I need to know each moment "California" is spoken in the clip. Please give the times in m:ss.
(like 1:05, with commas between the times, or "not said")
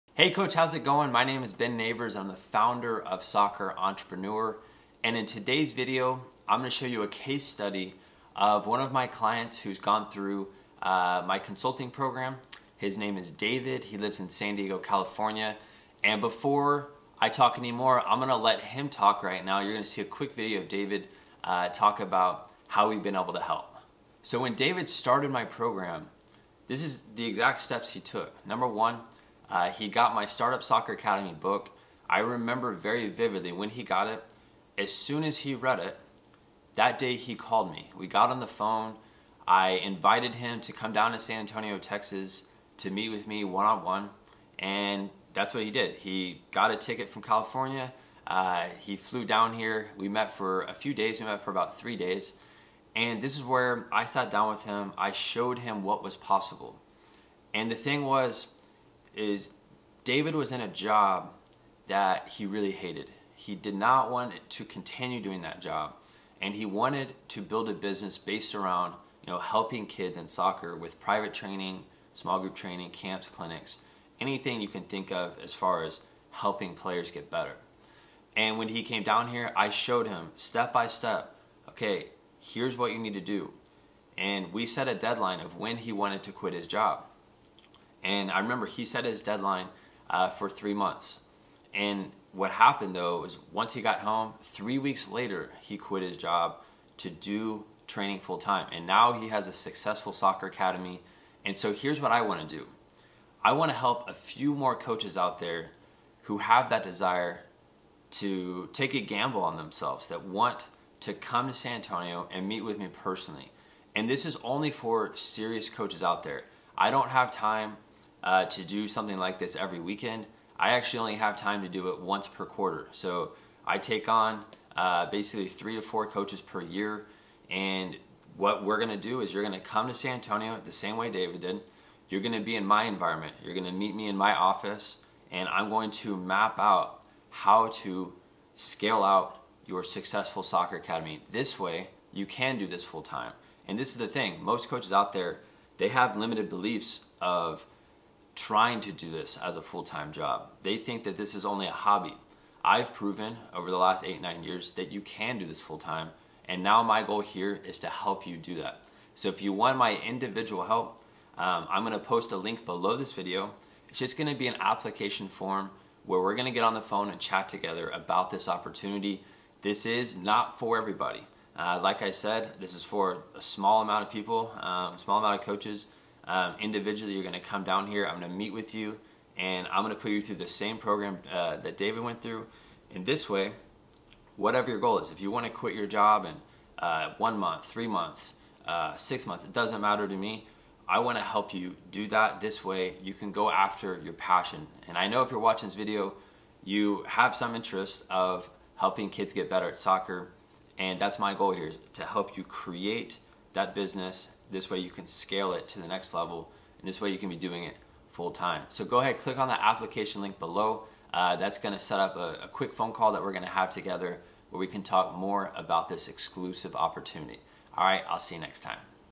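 0:14, 0:47.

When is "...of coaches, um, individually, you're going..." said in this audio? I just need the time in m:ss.
2:55.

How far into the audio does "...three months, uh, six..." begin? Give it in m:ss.
3:07.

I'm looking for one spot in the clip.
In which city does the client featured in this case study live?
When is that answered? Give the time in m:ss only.
0:14.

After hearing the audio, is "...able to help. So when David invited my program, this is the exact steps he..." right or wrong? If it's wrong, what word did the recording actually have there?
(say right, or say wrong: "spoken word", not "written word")
wrong: "started", not "invited".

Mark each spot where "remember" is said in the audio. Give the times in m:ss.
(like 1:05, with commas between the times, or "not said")
0:32, 1:28.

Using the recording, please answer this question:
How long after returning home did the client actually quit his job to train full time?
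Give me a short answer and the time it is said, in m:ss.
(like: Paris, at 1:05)
3 weeks, at 1:34.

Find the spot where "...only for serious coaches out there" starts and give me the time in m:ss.
1:54.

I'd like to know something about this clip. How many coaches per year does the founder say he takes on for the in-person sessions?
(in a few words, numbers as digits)
3 to 4.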